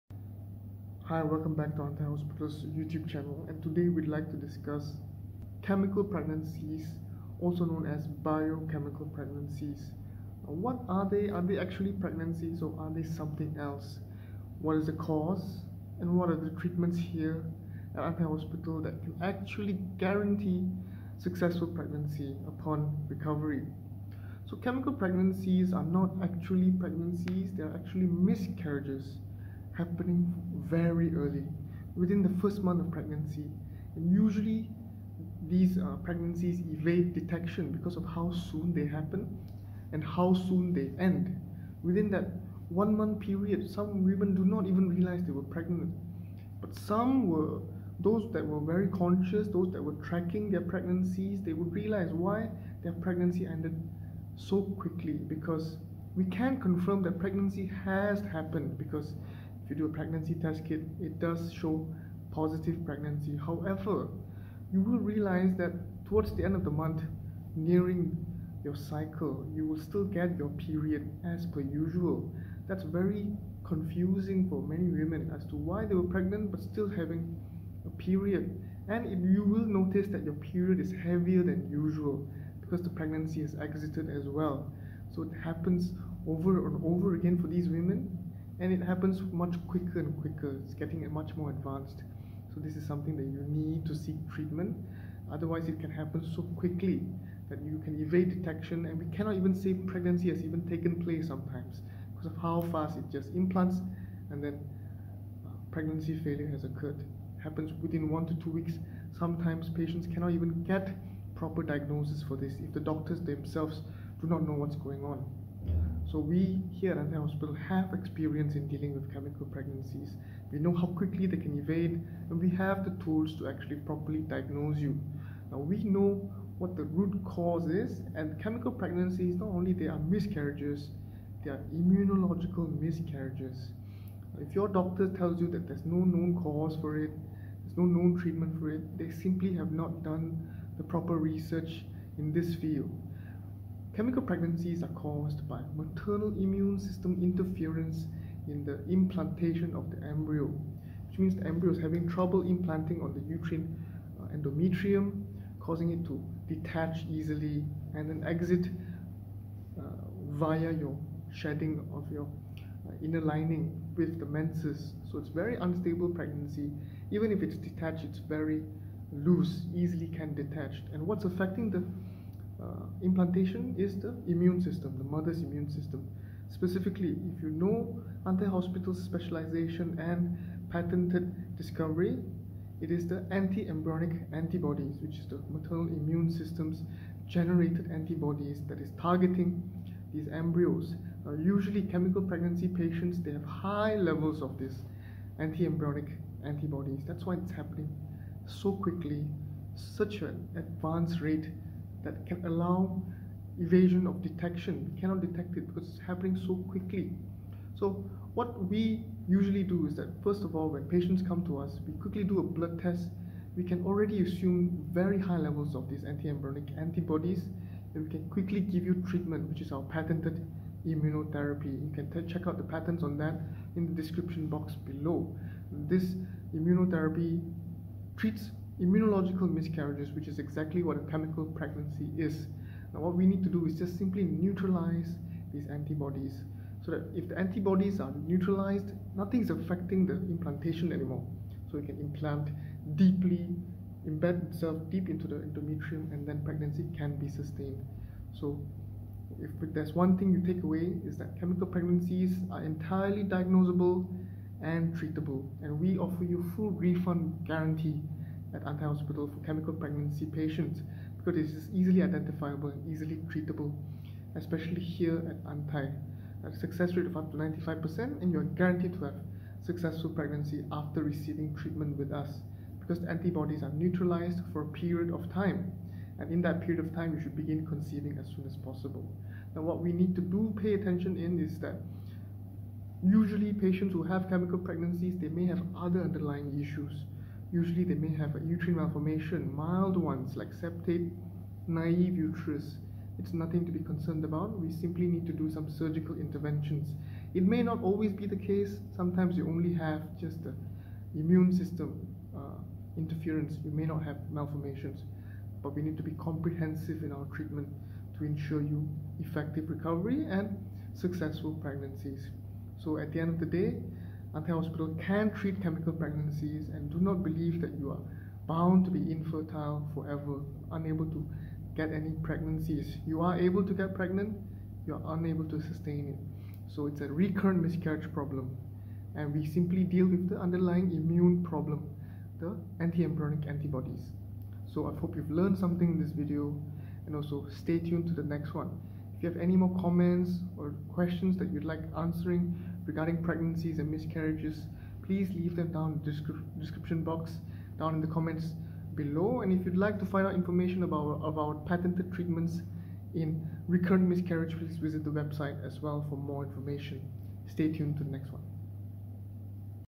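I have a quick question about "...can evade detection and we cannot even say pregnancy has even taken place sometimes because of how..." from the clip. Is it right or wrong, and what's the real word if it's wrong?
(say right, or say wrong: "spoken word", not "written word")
right.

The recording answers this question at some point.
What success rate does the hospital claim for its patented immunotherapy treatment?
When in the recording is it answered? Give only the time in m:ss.
4:27.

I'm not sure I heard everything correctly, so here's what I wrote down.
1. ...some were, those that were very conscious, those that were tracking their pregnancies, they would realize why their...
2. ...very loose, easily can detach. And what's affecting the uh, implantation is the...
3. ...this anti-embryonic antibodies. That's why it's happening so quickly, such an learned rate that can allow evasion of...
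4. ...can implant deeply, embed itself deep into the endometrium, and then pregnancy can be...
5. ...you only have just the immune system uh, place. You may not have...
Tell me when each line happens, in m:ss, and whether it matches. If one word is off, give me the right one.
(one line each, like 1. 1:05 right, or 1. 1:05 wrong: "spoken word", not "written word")
1. 0:46 right
2. 2:48 right
3. 3:14 wrong: "advanced", not "learned"
4. 4:01 right
5. 4:59 wrong: "interference", not "place".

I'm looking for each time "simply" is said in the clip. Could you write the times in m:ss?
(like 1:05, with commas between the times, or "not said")
2:19, 3:53, 4:54, 5:29.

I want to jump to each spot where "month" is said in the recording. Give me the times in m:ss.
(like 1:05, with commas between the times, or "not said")
0:32, 0:42, 1:06.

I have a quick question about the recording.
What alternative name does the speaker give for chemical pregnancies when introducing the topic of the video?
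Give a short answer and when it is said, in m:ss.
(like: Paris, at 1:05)
biochemical pregnancies, at 0:08.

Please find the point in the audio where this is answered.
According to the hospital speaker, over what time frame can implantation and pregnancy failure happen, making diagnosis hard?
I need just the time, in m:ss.
1:48.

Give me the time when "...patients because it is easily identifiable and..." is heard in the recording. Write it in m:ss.
4:20.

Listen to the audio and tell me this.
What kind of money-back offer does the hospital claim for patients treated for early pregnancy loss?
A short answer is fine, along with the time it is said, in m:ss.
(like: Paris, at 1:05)
full refund guarantee, at 4:16.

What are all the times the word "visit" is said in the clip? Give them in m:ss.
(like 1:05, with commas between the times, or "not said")
5:54.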